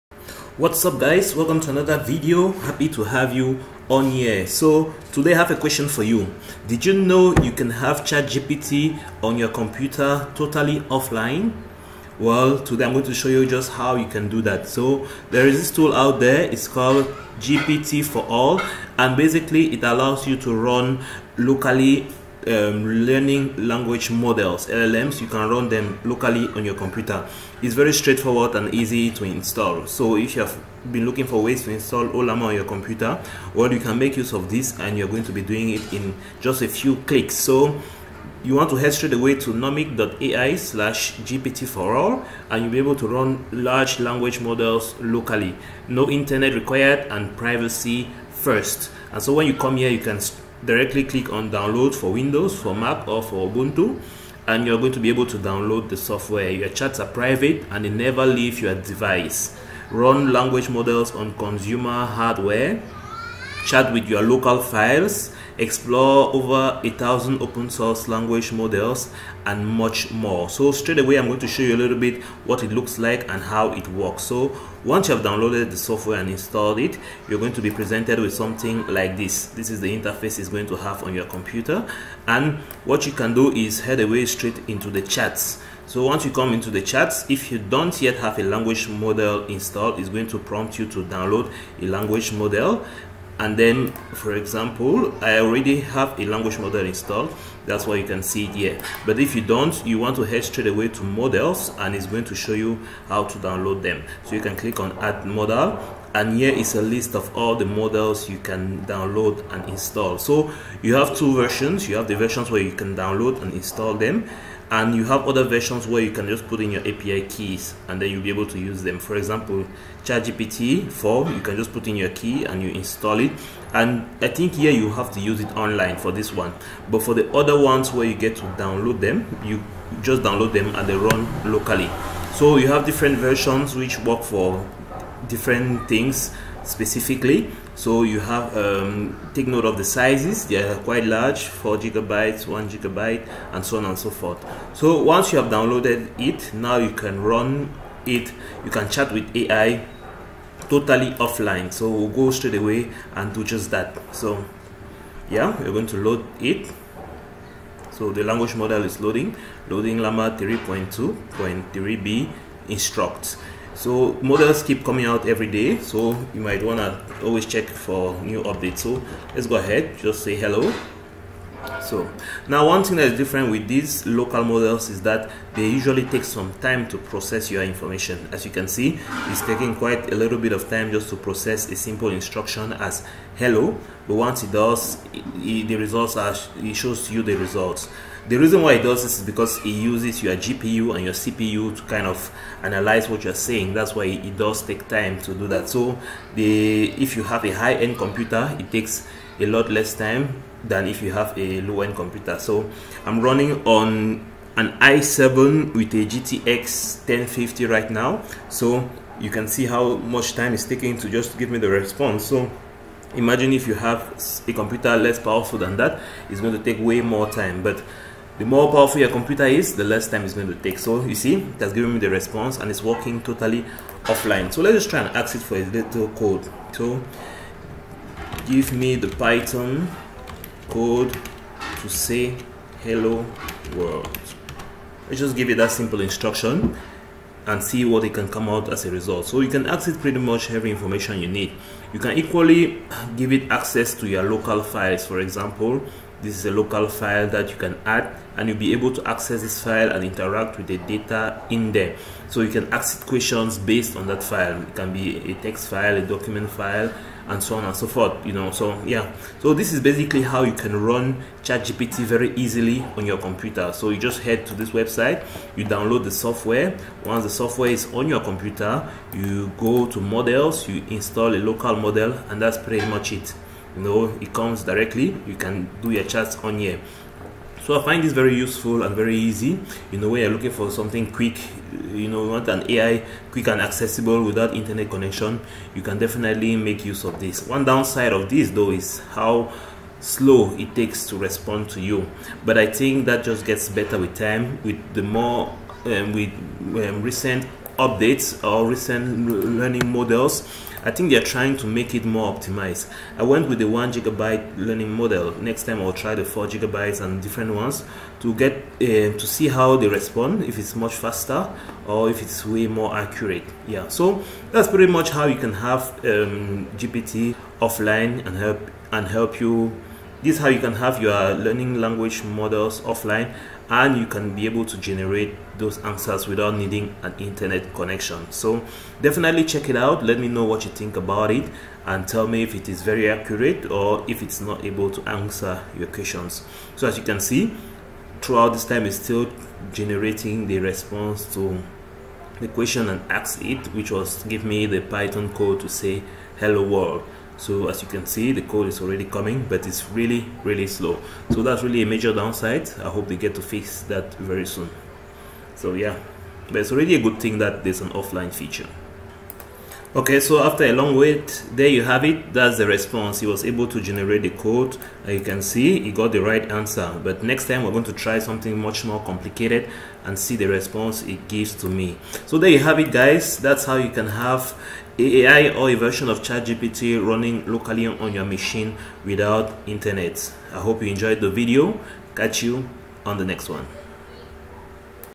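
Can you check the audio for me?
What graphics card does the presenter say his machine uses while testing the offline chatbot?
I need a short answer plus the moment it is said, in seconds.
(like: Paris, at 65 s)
GTX 1050, at 206 s.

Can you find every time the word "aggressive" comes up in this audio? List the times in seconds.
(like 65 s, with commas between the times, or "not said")
not said.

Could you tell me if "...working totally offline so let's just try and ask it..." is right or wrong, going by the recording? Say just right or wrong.
right.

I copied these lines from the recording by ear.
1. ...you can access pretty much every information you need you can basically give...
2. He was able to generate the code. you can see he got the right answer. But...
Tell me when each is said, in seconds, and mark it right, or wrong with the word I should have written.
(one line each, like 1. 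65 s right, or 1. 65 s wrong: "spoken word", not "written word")
1. 239 s wrong: "equally", not "basically"
2. 363 s right.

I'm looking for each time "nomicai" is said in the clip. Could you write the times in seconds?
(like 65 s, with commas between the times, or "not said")
39 s.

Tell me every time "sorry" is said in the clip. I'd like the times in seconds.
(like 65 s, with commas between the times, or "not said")
not said.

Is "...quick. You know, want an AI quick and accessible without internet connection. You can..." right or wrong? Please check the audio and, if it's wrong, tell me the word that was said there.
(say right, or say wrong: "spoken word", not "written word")
right.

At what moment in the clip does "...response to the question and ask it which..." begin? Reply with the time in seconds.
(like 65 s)
340 s.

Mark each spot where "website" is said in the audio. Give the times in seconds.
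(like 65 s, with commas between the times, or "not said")
264 s.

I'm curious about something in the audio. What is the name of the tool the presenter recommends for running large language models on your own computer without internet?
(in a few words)
GPT4All.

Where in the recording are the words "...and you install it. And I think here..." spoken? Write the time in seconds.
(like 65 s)
122 s.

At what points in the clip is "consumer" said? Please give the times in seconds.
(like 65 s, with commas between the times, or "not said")
61 s.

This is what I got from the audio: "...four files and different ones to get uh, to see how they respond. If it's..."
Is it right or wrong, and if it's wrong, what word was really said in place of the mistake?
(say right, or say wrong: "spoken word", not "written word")
wrong: "gigabytes", not "files".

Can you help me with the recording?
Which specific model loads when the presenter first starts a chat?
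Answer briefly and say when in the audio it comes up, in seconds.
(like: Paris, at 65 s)
Llama 3.2 3B Instruct, at 159 s.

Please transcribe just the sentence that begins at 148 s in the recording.
You can chat with AI totally offline.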